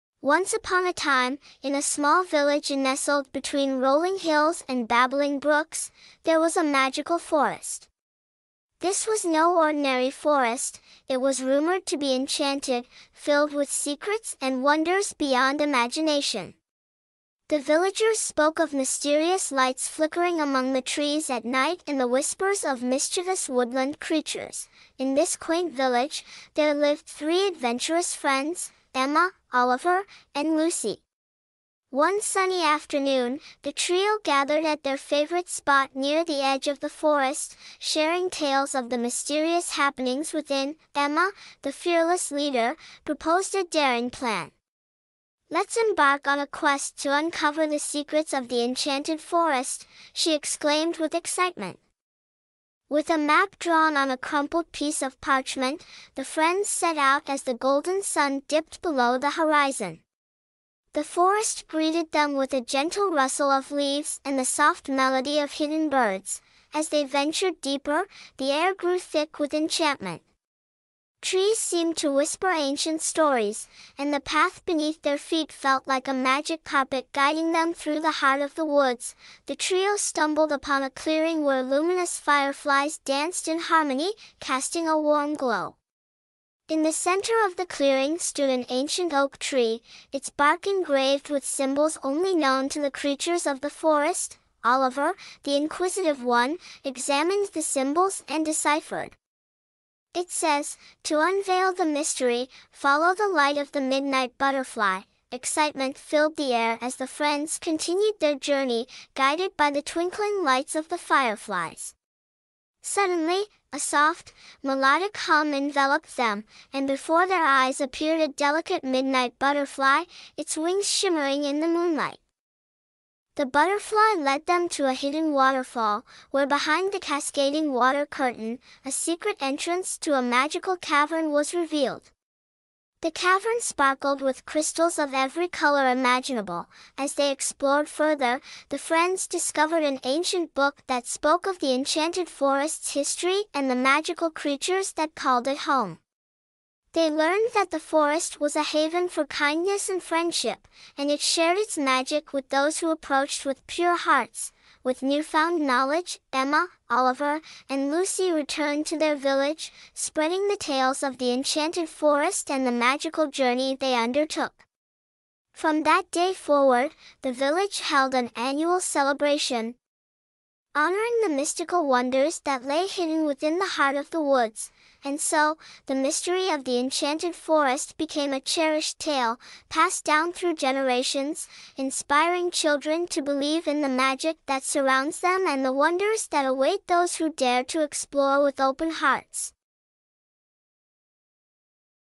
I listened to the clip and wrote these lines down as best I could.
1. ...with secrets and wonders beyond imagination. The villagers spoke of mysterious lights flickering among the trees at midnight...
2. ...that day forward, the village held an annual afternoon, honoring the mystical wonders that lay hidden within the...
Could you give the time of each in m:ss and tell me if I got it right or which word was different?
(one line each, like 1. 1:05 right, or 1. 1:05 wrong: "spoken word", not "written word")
1. 0:13 wrong: "night", not "midnight"
2. 2:45 wrong: "celebration", not "afternoon".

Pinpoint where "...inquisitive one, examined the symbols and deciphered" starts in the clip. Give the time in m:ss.
1:35.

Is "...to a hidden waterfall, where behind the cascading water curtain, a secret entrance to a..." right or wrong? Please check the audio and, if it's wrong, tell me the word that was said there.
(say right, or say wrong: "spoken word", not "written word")
right.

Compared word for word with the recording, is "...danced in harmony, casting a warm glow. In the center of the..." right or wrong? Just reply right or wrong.
right.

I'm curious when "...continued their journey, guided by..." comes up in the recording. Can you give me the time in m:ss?
1:47.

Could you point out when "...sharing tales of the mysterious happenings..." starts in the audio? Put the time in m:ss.
0:37.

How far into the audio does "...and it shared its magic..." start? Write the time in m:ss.
2:30.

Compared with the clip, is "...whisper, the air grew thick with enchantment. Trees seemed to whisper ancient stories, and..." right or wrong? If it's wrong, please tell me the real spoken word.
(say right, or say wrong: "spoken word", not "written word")
wrong: "deeper", not "whisper".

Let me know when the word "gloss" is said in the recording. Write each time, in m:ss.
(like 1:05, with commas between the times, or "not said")
not said.